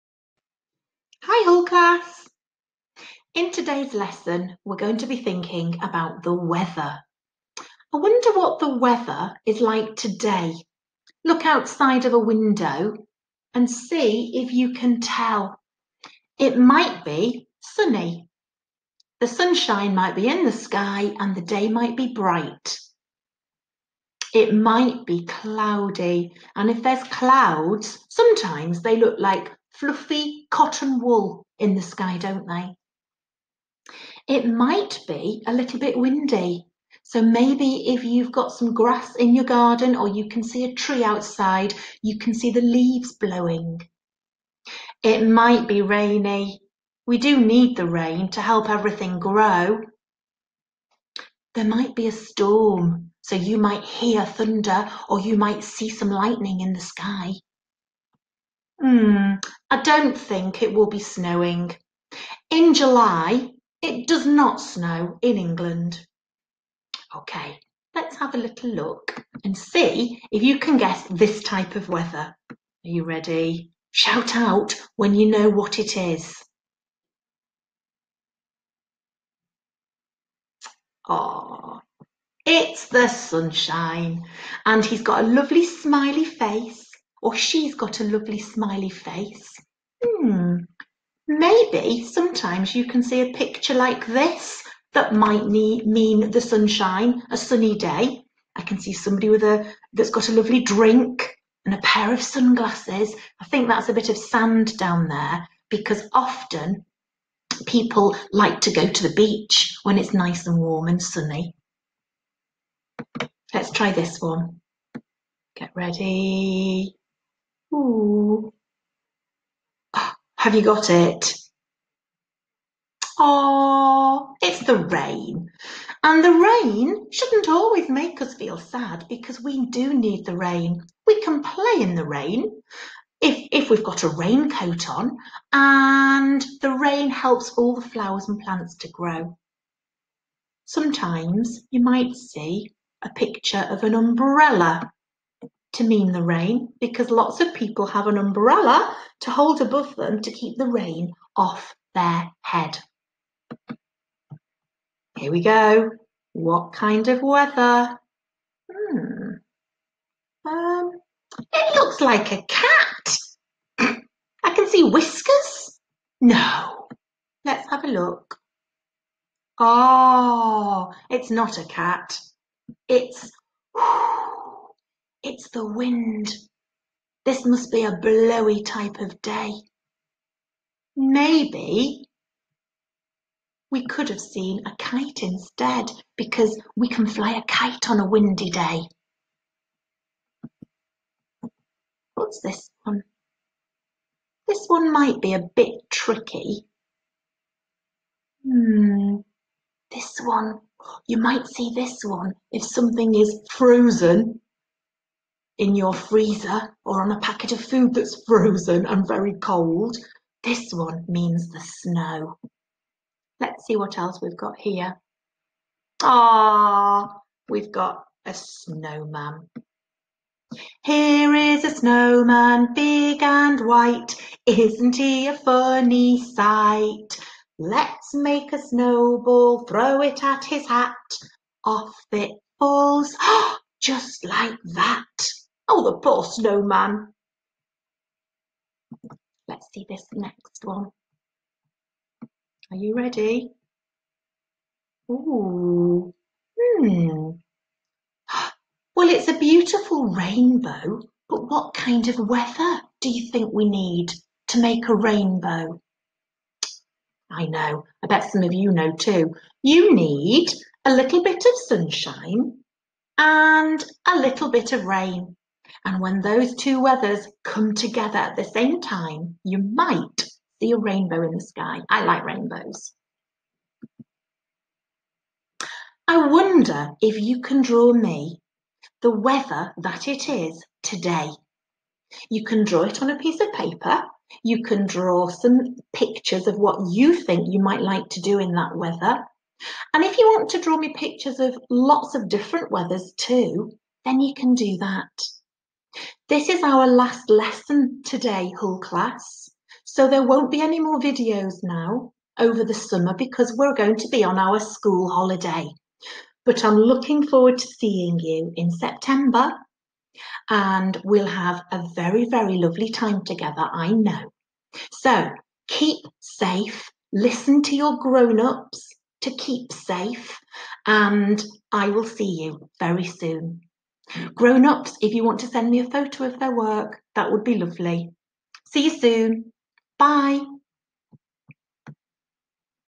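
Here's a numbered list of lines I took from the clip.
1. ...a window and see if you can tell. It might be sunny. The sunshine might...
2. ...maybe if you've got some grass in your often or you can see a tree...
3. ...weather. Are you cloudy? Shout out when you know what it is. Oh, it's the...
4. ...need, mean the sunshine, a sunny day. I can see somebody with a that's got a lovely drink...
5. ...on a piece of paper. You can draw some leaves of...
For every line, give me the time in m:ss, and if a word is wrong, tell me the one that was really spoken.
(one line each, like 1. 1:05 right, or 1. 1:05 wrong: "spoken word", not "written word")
1. 0:12 right
2. 0:37 wrong: "garden", not "often"
3. 1:11 wrong: "ready", not "cloudy"
4. 1:35 right
5. 4:43 wrong: "pictures", not "leaves".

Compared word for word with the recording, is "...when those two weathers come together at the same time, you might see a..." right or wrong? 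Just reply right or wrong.
right.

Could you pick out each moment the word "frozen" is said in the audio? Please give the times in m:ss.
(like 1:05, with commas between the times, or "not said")
3:23, 3:28.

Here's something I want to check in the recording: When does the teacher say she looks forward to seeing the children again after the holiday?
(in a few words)
September.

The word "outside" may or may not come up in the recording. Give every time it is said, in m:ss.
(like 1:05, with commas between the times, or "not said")
0:11, 0:41.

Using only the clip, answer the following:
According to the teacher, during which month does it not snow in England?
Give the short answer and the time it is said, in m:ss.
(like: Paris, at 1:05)
July, at 1:02.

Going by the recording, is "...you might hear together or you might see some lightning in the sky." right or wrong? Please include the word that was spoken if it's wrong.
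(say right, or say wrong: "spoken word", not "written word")
wrong: "thunder", not "together".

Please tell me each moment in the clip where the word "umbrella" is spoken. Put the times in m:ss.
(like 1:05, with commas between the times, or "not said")
2:23, 2:28.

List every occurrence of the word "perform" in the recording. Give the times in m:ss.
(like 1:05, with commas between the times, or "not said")
not said.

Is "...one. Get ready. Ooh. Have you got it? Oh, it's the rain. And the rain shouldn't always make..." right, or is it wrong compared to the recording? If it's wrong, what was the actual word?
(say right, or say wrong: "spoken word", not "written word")
right.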